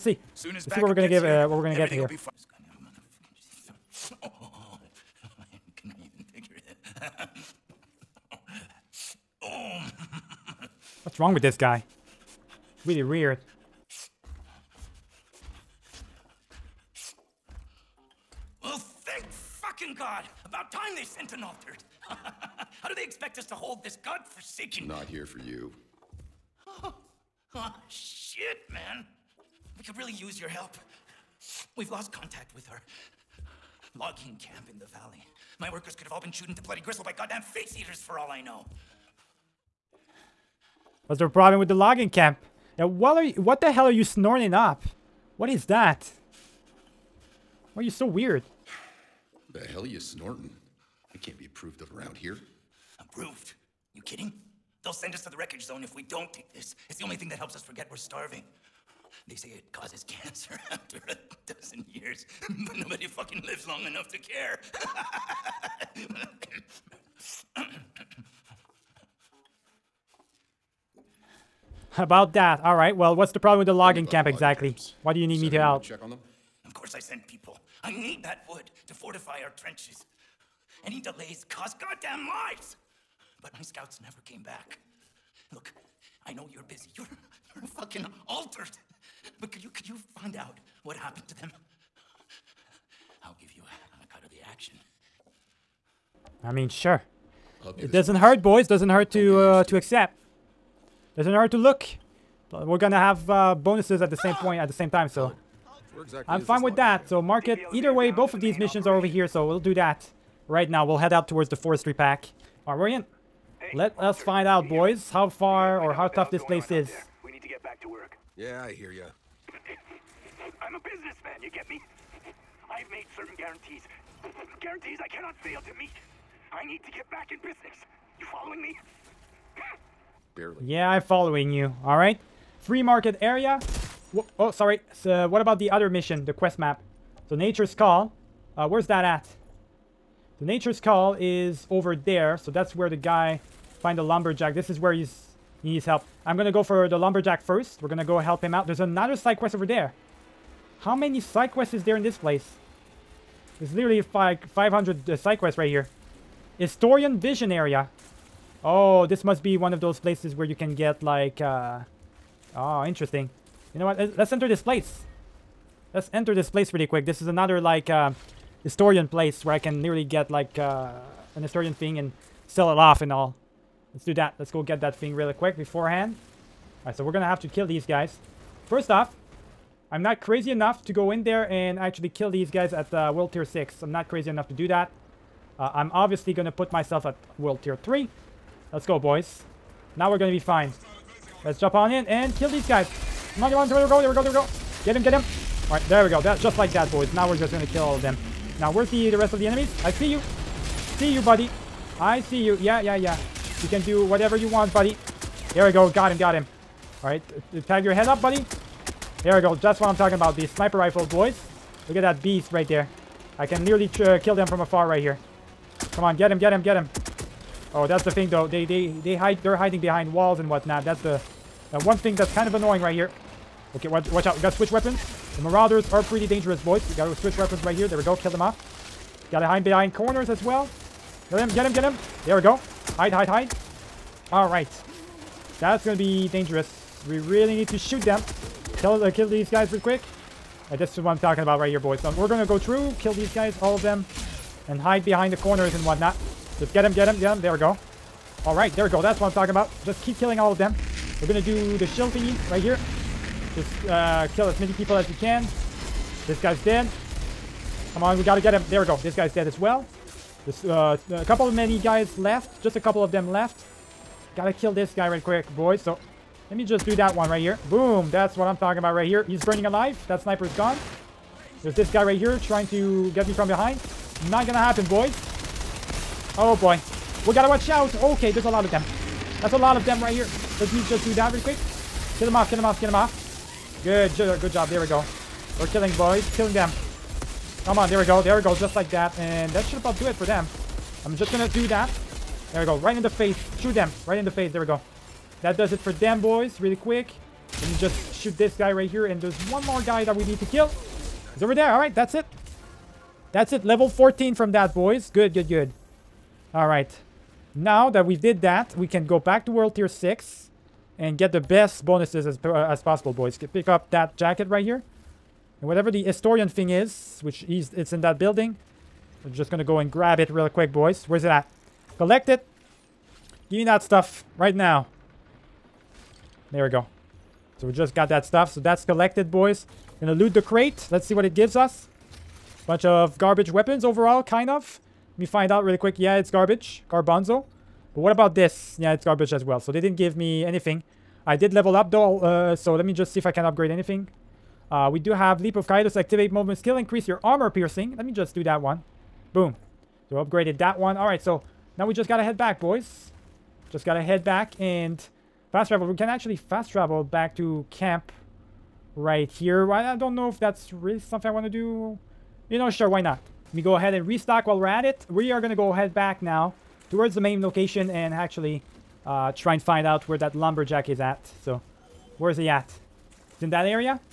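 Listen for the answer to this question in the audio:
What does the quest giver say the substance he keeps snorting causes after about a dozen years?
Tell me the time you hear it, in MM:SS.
01:00.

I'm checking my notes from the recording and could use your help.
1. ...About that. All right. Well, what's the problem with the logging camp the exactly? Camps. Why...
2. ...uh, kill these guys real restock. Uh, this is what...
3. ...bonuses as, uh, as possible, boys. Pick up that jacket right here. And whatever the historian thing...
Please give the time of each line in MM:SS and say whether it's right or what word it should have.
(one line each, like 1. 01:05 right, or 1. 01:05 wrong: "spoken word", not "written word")
1. 01:11 right
2. 03:59 wrong: "quick", not "restock"
3. 05:11 right.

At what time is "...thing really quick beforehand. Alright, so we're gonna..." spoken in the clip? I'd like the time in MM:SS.
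02:54.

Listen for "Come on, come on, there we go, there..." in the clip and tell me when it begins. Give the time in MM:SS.
03:13.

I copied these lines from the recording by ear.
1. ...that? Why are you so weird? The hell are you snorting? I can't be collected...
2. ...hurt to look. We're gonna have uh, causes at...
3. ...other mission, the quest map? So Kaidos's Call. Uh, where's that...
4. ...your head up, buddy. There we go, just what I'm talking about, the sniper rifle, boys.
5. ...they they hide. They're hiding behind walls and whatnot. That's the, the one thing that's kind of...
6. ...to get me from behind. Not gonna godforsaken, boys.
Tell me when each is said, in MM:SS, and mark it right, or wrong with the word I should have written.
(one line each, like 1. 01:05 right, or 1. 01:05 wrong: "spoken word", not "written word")
1. 00:45 wrong: "approved", not "collected"
2. 01:41 wrong: "bonuses", not "causes"
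3. 02:15 wrong: "Nature", not "Kaidos"
4. 03:27 right
5. 03:38 right
6. 04:32 wrong: "happen", not "godforsaken".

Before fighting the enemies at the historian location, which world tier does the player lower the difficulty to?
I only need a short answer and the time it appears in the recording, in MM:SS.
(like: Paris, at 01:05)
World Tier 3, at 03:07.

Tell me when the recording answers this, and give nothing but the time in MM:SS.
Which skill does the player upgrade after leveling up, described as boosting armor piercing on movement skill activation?
05:45.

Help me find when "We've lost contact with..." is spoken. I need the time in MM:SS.
00:31.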